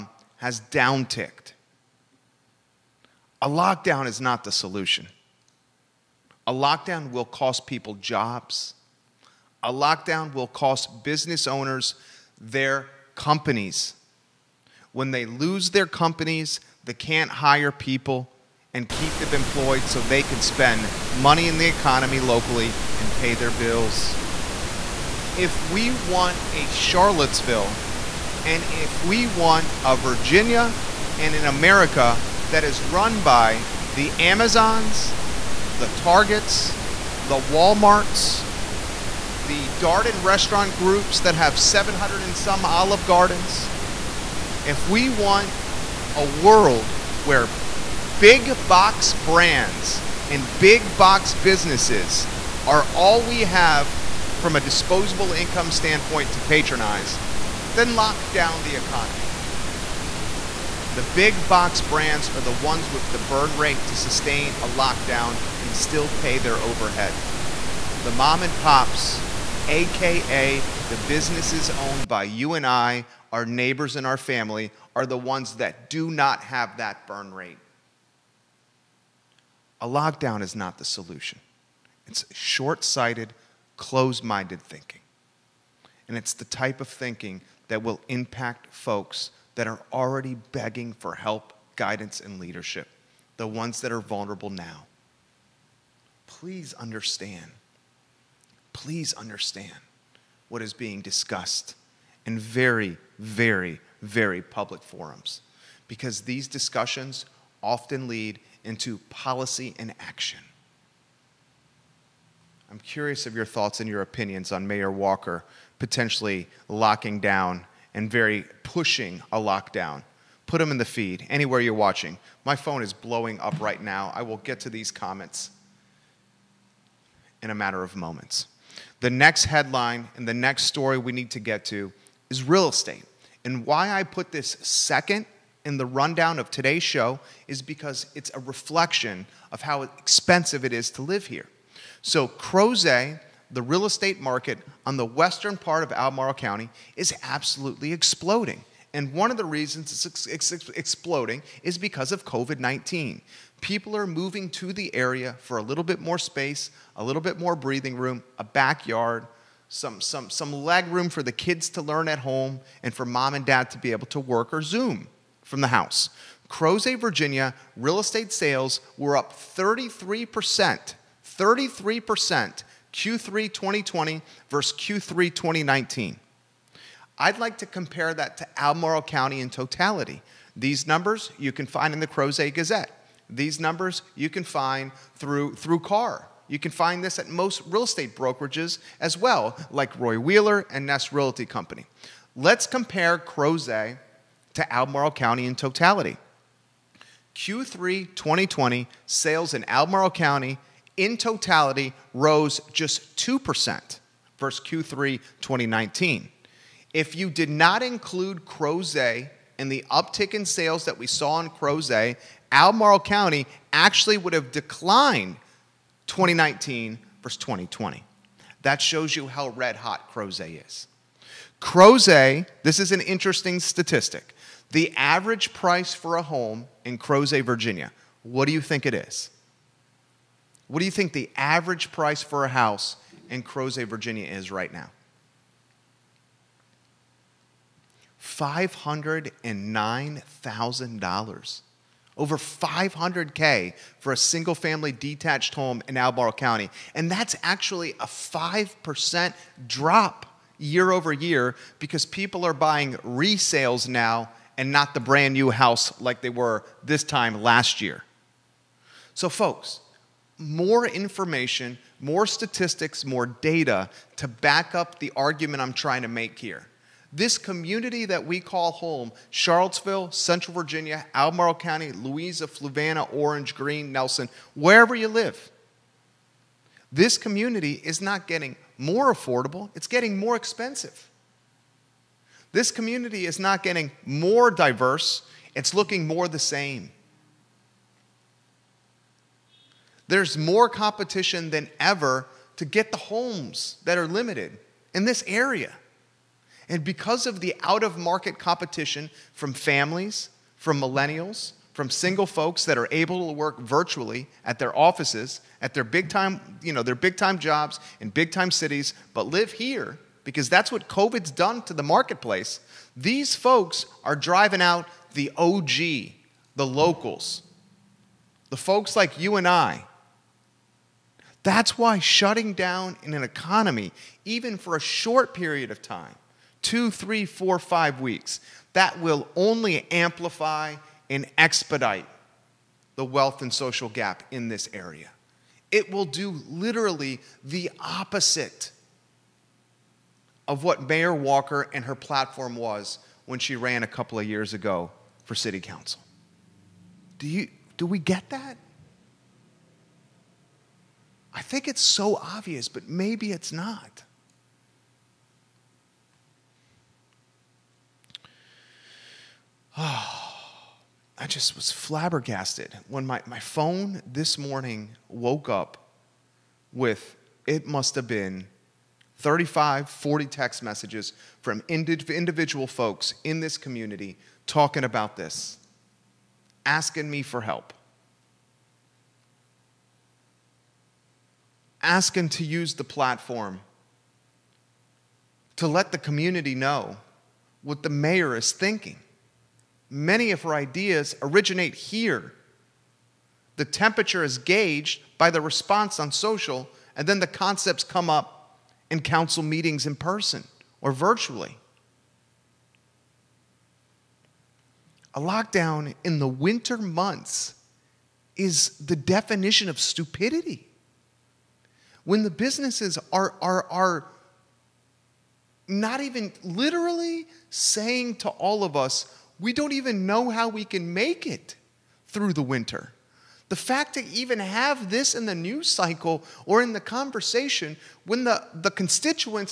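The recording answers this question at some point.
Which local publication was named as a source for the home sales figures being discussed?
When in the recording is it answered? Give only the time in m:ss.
3:02.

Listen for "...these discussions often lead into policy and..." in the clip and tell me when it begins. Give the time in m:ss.
1:46.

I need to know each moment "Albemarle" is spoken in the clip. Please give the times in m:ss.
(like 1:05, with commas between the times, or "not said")
2:25, 2:58, 3:14, 3:19, 3:32, 4:05, 4:31.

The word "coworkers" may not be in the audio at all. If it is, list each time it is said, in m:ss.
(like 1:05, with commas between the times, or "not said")
not said.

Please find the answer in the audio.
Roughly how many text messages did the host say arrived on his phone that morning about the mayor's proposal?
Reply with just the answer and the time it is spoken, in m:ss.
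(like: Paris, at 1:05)
35 to 40, at 6:09.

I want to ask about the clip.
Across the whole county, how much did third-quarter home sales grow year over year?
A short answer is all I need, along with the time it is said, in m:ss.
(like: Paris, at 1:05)
2%, at 3:23.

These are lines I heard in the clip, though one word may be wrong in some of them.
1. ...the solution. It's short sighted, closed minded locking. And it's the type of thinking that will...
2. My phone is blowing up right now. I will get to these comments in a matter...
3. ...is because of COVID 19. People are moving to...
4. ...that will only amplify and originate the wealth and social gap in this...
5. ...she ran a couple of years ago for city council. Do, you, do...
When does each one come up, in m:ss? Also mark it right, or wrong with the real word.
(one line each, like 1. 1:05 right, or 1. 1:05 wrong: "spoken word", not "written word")
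1. 1:20 wrong: "thinking", not "locking"
2. 2:02 right
3. 2:31 right
4. 5:28 wrong: "expedite", not "originate"
5. 5:43 right.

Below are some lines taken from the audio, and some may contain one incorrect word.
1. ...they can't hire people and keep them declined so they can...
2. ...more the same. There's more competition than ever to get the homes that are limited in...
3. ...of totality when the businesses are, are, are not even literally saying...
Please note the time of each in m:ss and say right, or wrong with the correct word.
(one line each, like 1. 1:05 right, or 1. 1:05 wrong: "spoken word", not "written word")
1. 0:16 wrong: "employed", not "declined"
2. 4:46 right
3. 6:49 wrong: "stupidity", not "totality".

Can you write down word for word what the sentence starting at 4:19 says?
So, folks, more information, more statistics, more data to back up the argument I'm trying to make here.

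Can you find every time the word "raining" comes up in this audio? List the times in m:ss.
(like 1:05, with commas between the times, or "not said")
not said.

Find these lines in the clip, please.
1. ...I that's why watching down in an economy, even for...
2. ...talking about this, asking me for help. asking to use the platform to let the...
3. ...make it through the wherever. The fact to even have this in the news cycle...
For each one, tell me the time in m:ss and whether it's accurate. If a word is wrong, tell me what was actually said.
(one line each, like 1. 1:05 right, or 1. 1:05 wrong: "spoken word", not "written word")
1. 5:19 wrong: "shutting", not "watching"
2. 6:14 right
3. 7:00 wrong: "winter", not "wherever".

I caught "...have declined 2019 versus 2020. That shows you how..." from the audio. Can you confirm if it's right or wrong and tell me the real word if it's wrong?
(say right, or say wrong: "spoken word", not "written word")
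right.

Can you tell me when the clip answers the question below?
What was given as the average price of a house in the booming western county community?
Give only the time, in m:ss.
3:58.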